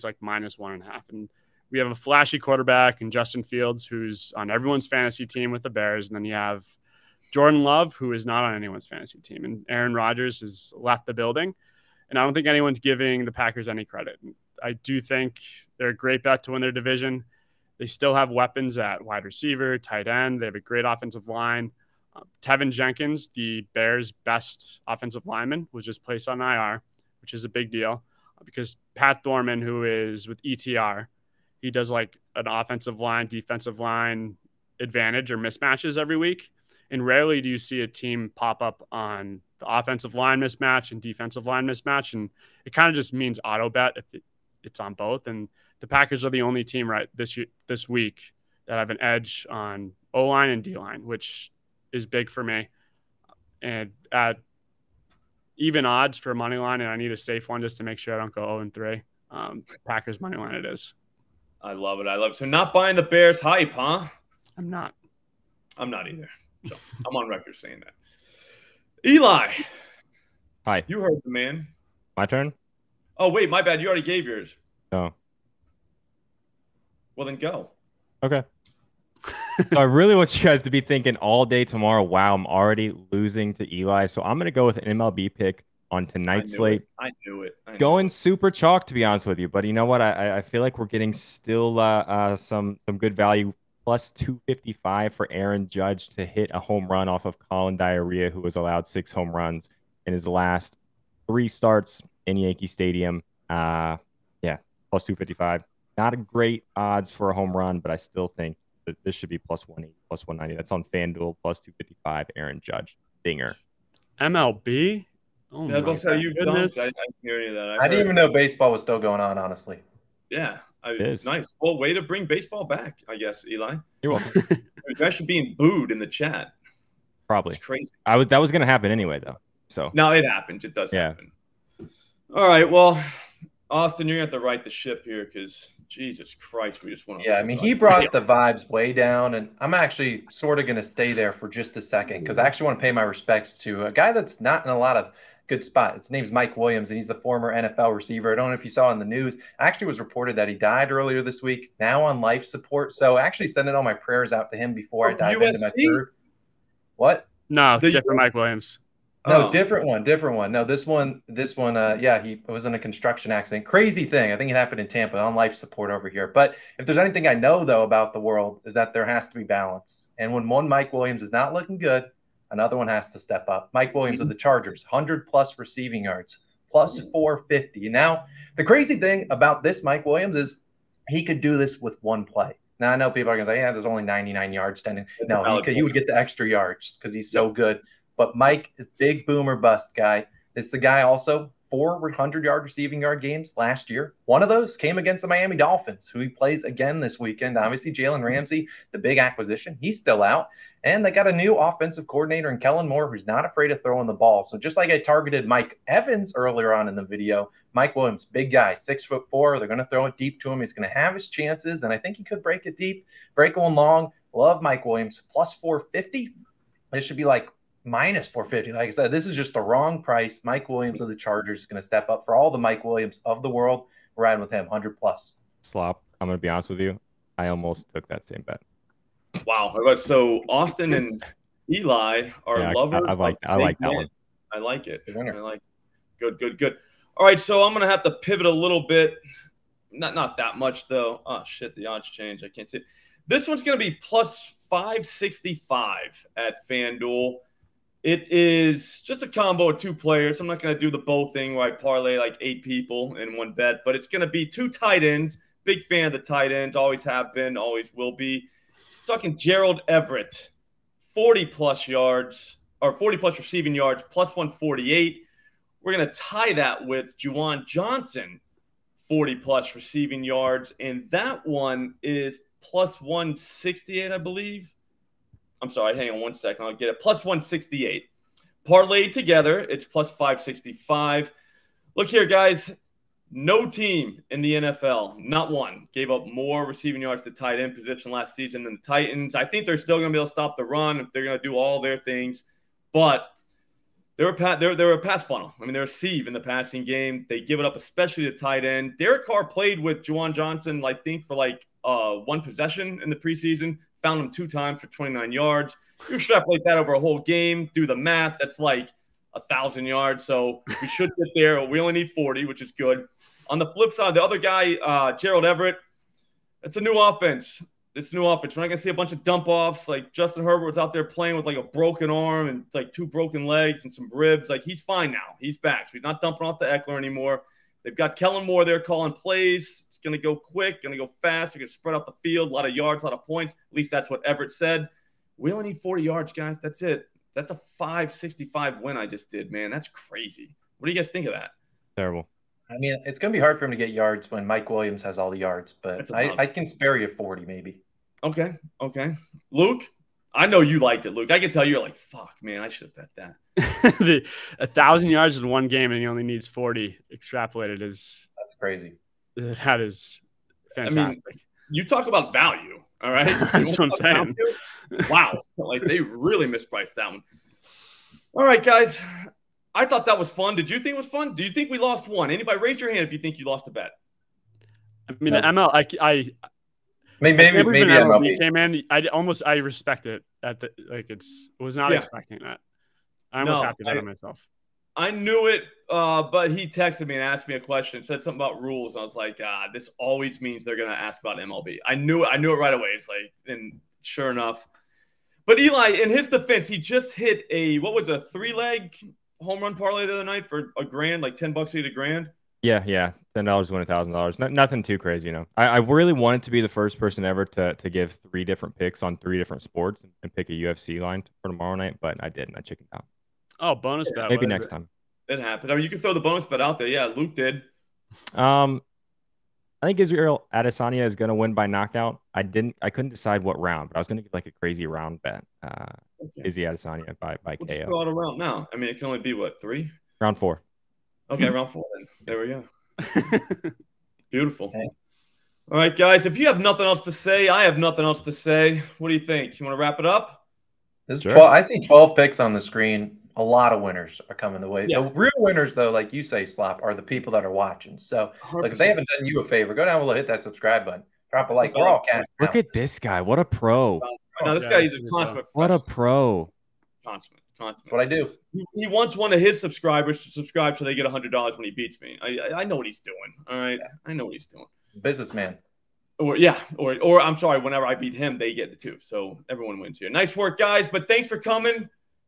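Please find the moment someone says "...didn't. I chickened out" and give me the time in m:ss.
6:52.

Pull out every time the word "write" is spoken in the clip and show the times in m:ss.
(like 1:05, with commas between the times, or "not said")
2:14.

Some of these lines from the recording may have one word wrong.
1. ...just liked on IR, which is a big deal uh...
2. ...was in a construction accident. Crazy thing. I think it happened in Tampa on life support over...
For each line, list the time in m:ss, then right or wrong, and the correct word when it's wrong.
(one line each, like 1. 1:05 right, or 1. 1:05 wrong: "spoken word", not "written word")
1. 0:25 wrong: "placed", not "liked"
2. 2:42 right.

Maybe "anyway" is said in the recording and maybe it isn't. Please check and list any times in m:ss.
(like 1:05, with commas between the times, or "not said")
2:08.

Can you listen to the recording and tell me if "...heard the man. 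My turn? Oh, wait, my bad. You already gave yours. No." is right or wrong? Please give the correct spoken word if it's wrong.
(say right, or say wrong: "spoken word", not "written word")
right.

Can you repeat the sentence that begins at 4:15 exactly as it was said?
Big fan of the tight ends, always have been, always will be.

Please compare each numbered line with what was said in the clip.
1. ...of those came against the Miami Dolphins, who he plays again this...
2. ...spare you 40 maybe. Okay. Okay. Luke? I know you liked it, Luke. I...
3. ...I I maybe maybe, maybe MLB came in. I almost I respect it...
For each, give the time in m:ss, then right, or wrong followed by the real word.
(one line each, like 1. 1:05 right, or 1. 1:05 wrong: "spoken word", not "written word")
1. 3:14 right
2. 5:46 right
3. 6:16 right.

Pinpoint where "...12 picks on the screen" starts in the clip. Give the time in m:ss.
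7:21.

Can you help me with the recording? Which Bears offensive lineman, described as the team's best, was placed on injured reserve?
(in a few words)
Teven Jenkins.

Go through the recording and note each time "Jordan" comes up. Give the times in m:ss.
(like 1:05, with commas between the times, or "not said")
0:07.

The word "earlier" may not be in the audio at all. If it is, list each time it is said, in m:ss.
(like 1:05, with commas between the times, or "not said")
2:30, 3:26.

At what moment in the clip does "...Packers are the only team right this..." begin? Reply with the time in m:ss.
0:45.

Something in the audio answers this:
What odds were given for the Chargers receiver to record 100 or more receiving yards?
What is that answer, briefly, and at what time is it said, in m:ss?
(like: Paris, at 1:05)
+450, at 3:35.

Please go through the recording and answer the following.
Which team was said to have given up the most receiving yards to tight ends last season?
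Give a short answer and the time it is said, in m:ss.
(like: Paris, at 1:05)
Titans, at 4:48.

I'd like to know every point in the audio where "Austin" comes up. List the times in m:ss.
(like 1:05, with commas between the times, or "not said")
2:13, 3:50.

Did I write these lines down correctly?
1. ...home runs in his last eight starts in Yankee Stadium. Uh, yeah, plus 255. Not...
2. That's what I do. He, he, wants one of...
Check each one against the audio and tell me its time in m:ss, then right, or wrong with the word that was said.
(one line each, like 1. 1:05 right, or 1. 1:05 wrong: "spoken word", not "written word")
1. 1:39 wrong: "three", not "eight"
2. 7:37 right.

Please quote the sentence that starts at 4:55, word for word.
I mean, they're a sieve in the passing game.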